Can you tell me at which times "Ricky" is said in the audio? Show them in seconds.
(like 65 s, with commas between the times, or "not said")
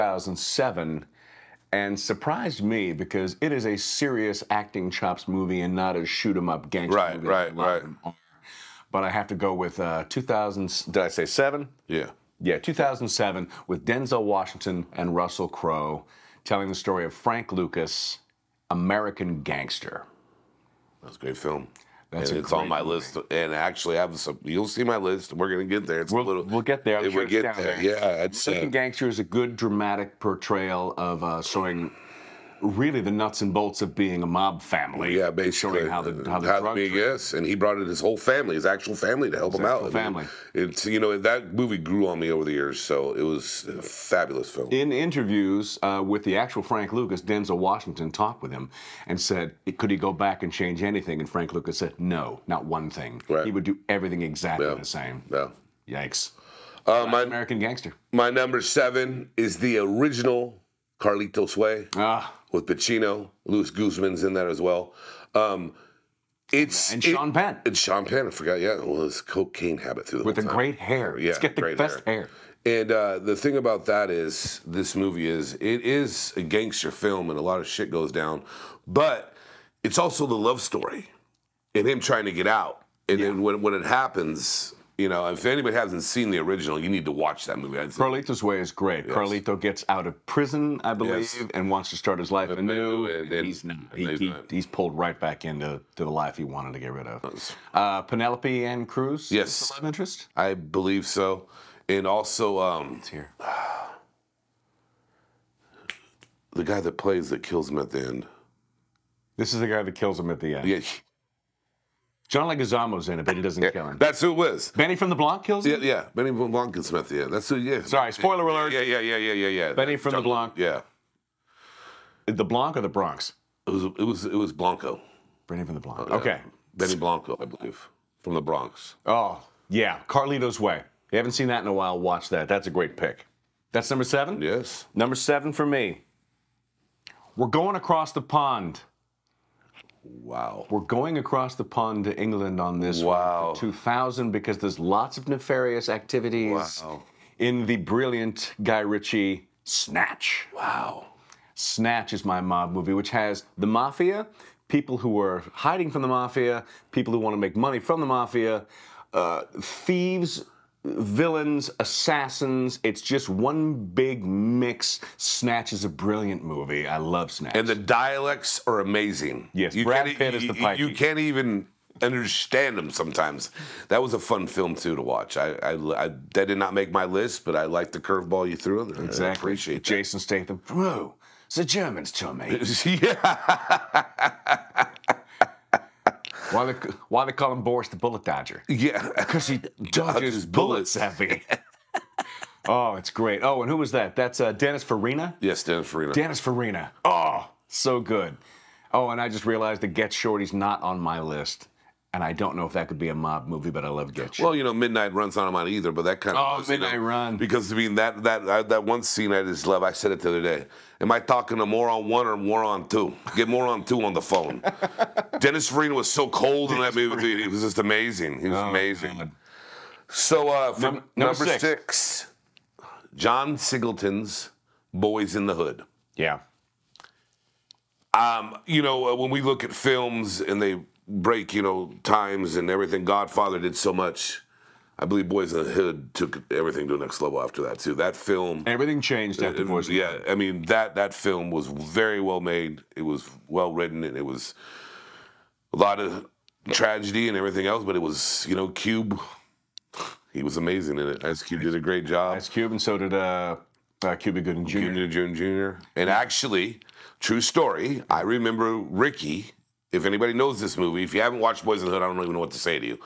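258 s.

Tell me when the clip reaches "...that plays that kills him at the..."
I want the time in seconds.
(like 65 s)
106 s.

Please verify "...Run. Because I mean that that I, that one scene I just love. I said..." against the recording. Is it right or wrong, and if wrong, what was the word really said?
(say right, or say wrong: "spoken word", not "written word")
right.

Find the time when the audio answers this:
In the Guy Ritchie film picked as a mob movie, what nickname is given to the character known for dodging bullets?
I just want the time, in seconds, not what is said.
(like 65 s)
187 s.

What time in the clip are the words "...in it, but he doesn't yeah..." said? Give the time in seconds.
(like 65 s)
113 s.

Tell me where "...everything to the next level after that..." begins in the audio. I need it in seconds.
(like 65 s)
236 s.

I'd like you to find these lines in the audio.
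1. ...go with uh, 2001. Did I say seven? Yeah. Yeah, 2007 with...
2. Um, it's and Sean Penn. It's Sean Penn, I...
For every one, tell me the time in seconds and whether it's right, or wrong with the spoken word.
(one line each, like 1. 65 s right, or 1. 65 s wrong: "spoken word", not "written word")
1. 9 s wrong: "2000", not "2001"
2. 65 s right.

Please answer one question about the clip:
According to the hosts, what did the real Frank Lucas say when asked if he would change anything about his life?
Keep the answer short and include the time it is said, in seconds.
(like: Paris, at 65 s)
No, not one thing, at 51 s.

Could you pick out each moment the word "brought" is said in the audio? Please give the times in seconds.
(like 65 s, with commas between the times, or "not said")
37 s.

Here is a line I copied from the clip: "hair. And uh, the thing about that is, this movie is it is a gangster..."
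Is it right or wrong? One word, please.
right.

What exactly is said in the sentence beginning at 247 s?
But it was, you know, Cube.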